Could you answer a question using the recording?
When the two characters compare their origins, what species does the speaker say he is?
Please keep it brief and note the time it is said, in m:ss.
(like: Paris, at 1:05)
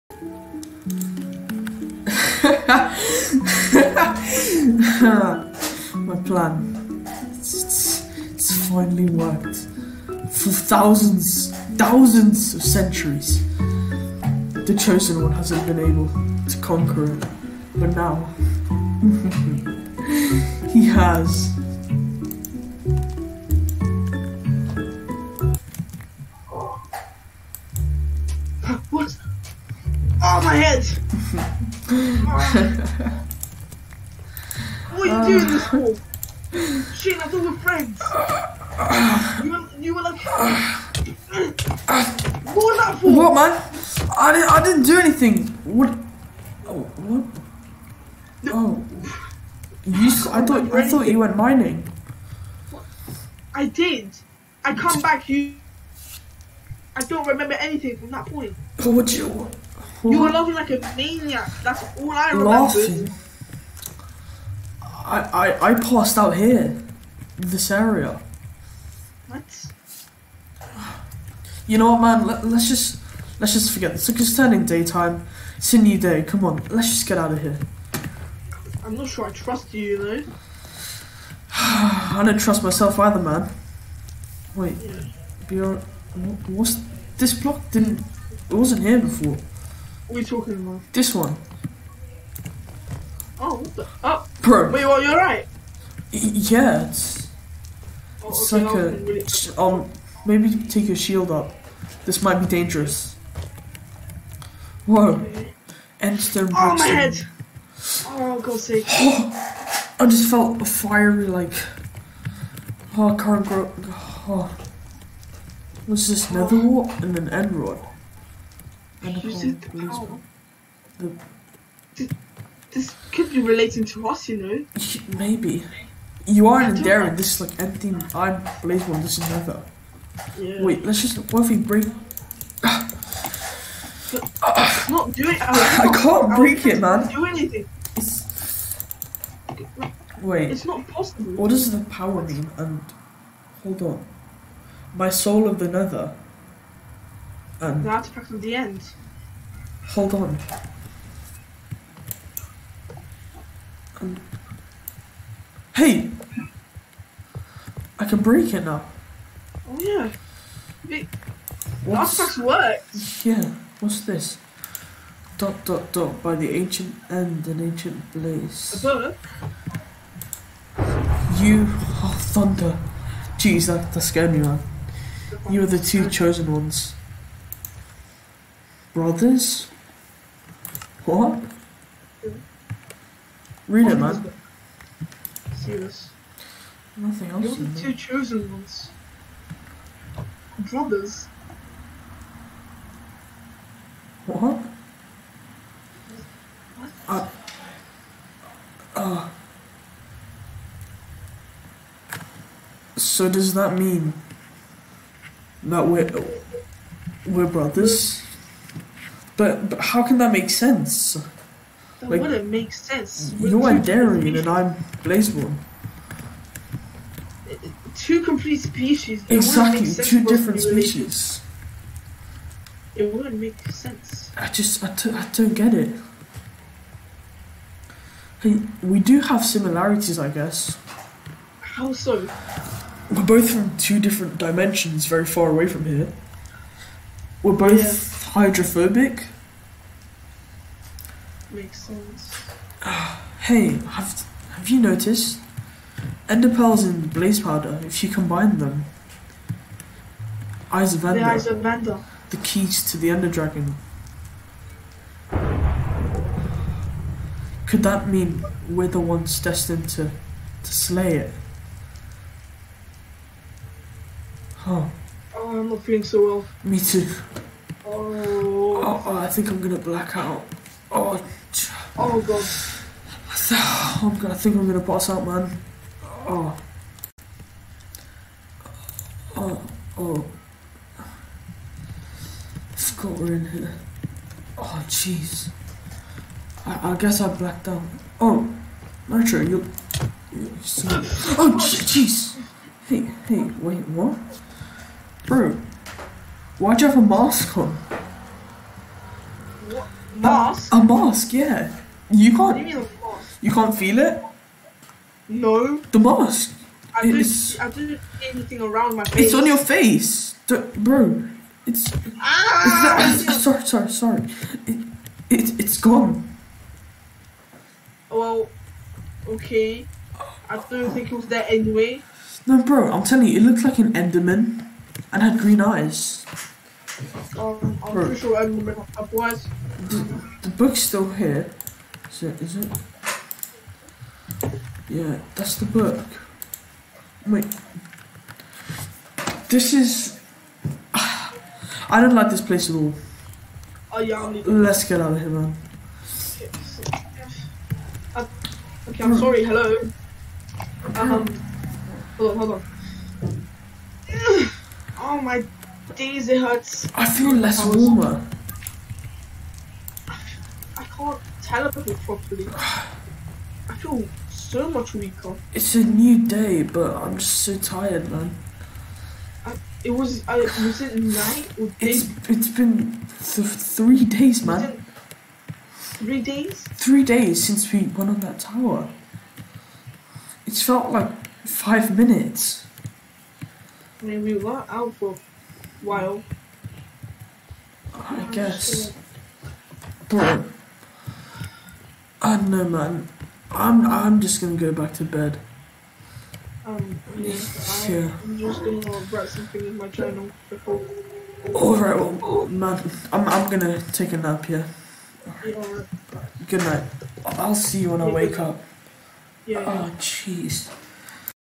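Blazeborn, at 3:35.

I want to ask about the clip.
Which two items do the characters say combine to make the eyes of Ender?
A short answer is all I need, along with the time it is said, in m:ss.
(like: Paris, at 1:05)
Ender pearls and blaze powder, at 4:06.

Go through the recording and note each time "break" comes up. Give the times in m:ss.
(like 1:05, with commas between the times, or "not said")
2:11, 2:16, 2:38.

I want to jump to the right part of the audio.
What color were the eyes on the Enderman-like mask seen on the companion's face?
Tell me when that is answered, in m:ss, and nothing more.
5:25.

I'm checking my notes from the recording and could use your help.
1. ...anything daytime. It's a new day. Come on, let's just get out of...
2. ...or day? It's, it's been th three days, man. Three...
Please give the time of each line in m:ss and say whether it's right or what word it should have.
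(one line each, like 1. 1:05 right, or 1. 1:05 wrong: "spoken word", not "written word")
1. 1:14 wrong: "turning", not "anything"
2. 6:11 right.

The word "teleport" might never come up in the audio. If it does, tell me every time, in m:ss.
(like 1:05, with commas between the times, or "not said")
6:01.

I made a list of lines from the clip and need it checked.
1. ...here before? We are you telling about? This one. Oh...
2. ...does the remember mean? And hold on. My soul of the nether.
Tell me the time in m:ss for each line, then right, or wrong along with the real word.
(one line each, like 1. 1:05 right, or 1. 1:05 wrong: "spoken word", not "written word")
1. 1:28 wrong: "talking", not "telling"
2. 2:21 wrong: "power", not "remember".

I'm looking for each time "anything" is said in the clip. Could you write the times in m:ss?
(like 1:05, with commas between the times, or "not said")
0:44, 0:57, 2:17, 5:08.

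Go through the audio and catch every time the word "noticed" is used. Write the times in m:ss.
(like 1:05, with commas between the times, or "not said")
4:04.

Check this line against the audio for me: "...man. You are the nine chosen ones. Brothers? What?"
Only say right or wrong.
wrong.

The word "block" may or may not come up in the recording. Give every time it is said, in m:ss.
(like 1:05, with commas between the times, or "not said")
1:27.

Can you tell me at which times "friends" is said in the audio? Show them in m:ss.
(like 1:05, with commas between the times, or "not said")
0:37.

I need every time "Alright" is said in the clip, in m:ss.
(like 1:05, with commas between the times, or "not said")
6:41.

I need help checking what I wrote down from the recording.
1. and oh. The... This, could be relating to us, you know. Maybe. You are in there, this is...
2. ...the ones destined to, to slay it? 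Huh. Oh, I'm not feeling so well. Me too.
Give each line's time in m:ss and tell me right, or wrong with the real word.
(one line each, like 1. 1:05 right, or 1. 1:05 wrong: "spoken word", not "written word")
1. 1:59 right
2. 4:18 right.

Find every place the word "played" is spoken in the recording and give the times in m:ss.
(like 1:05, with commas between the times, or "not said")
not said.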